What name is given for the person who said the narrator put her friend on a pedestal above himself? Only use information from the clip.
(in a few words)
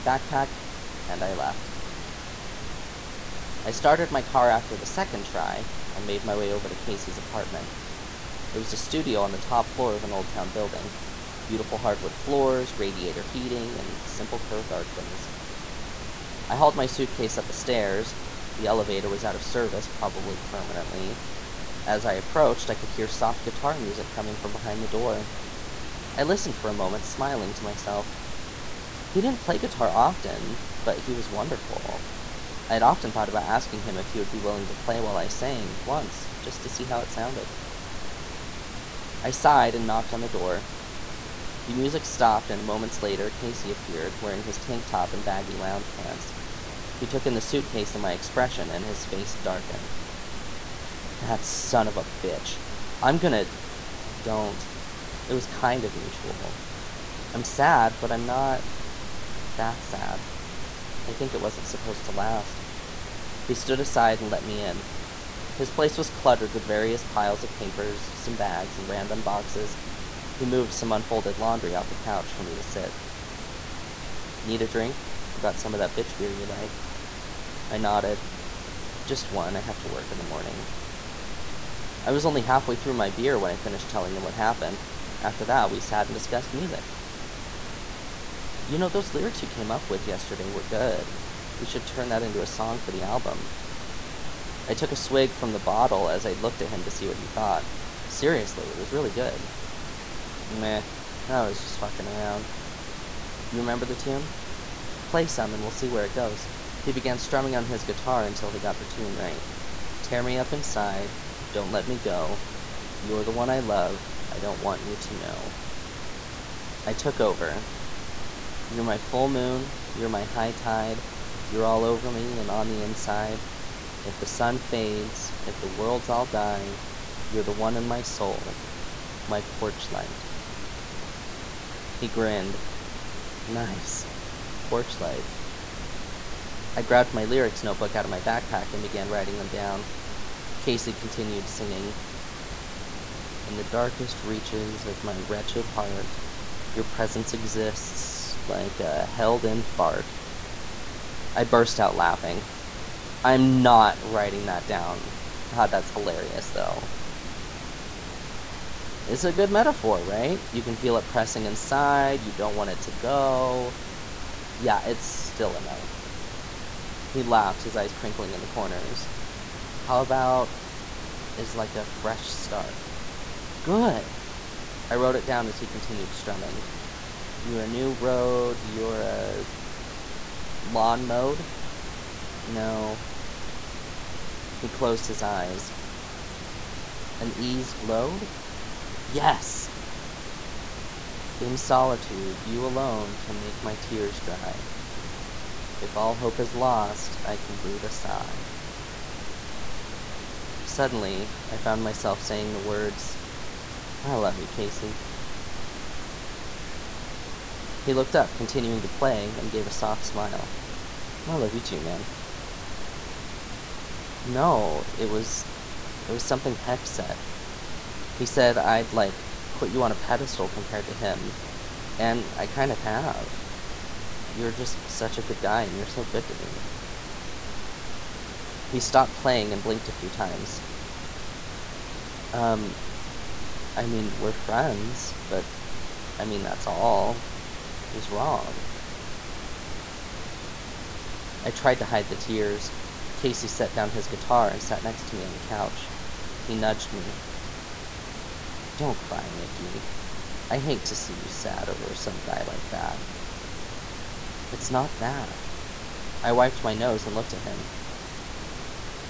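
Heck.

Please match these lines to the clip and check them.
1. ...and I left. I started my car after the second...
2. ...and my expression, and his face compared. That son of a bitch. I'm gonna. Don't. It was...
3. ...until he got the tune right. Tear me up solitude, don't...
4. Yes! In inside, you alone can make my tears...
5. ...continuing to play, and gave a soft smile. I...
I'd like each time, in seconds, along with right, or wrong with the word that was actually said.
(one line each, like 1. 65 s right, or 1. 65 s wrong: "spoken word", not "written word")
1. 1 s right
2. 47 s wrong: "darkened", not "compared"
3. 108 s wrong: "inside", not "solitude"
4. 189 s wrong: "solitude", not "inside"
5. 208 s right.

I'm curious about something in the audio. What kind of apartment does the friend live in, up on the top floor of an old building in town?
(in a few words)
studio.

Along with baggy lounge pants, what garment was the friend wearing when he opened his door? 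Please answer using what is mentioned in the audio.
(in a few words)
tank top.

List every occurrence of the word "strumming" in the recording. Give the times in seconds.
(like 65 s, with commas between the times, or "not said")
107 s, 176 s.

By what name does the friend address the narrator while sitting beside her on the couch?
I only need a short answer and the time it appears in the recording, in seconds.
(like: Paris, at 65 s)
Nikki, at 249 s.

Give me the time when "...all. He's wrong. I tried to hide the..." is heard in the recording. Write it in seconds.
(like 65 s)
236 s.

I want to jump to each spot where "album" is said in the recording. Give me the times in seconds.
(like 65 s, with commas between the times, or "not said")
93 s.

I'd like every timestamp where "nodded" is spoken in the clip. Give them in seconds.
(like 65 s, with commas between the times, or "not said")
77 s.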